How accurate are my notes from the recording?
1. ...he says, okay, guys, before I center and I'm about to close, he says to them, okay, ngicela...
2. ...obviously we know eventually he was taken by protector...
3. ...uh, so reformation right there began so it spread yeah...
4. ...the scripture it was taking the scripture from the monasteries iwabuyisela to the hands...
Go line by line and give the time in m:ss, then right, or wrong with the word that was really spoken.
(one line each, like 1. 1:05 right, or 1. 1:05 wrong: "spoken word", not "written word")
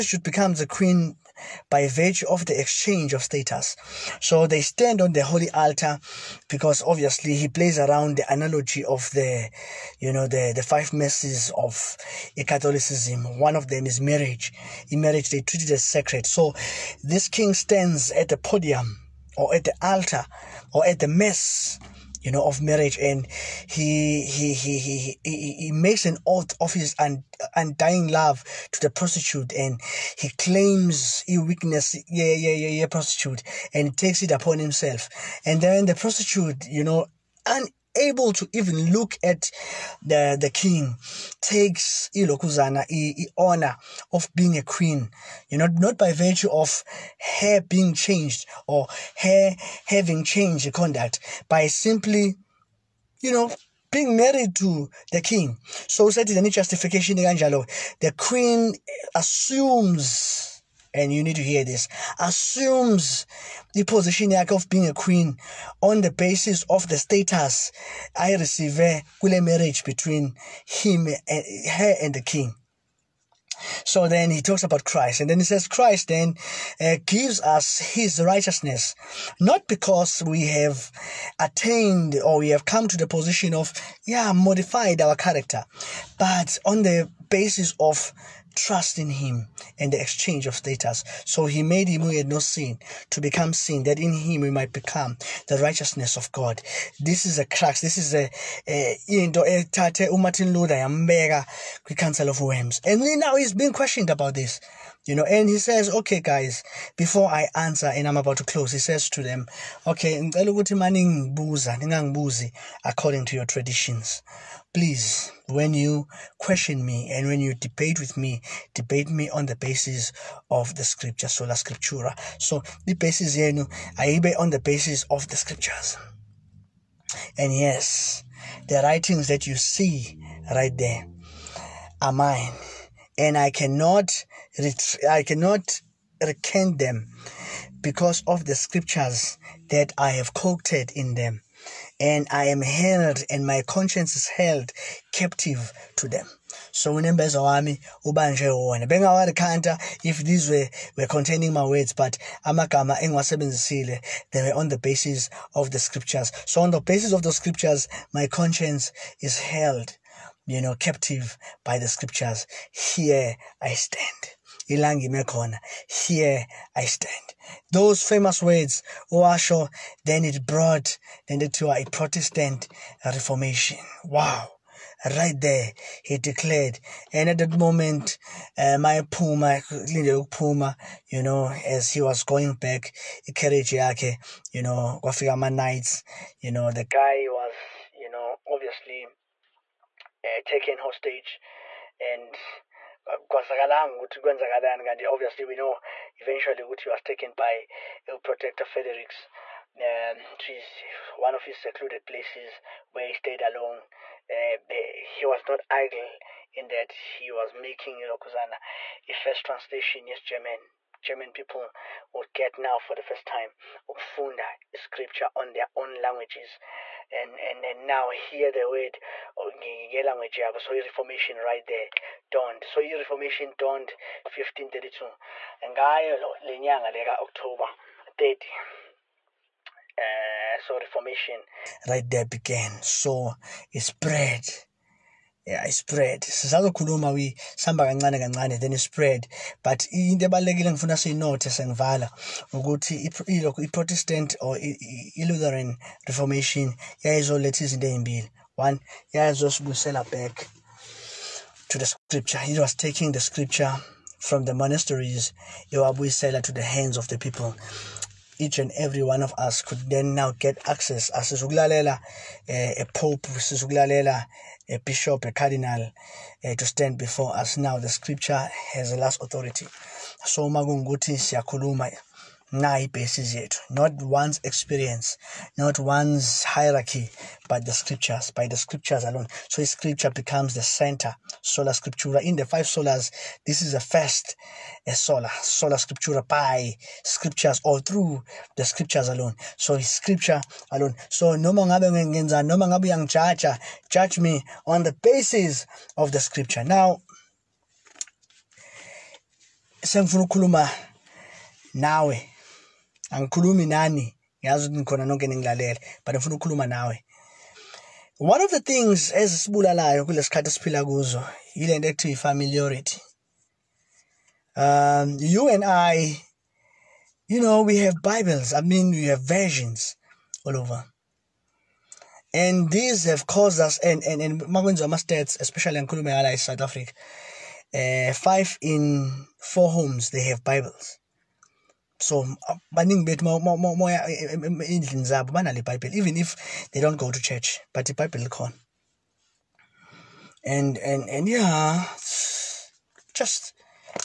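1. 1:45 wrong: "answer", not "center"
2. 3:15 right
3. 3:50 right
4. 4:11 right.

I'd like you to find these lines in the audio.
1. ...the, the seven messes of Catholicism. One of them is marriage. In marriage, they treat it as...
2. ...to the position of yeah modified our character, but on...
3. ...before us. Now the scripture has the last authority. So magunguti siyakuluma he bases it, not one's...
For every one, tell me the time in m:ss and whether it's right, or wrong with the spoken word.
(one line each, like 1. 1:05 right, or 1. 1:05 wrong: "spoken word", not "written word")
1. 0:10 wrong: "five", not "seven"
2. 1:22 right
3. 4:26 right.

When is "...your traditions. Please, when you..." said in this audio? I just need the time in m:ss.
1:53.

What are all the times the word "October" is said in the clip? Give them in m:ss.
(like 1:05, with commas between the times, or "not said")
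3:47.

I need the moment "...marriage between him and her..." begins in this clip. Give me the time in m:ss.
1:09.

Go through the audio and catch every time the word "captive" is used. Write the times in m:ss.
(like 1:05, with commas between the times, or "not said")
2:25, 2:40.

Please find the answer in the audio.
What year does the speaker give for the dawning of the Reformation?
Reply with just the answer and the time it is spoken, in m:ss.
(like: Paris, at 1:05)
1532, at 3:44.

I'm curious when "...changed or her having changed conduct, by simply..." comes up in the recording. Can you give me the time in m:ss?
0:47.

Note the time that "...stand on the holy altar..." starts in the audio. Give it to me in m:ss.
0:04.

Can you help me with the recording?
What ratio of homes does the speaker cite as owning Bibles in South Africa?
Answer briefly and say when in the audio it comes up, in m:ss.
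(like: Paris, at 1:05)
Five in four homes, at 5:28.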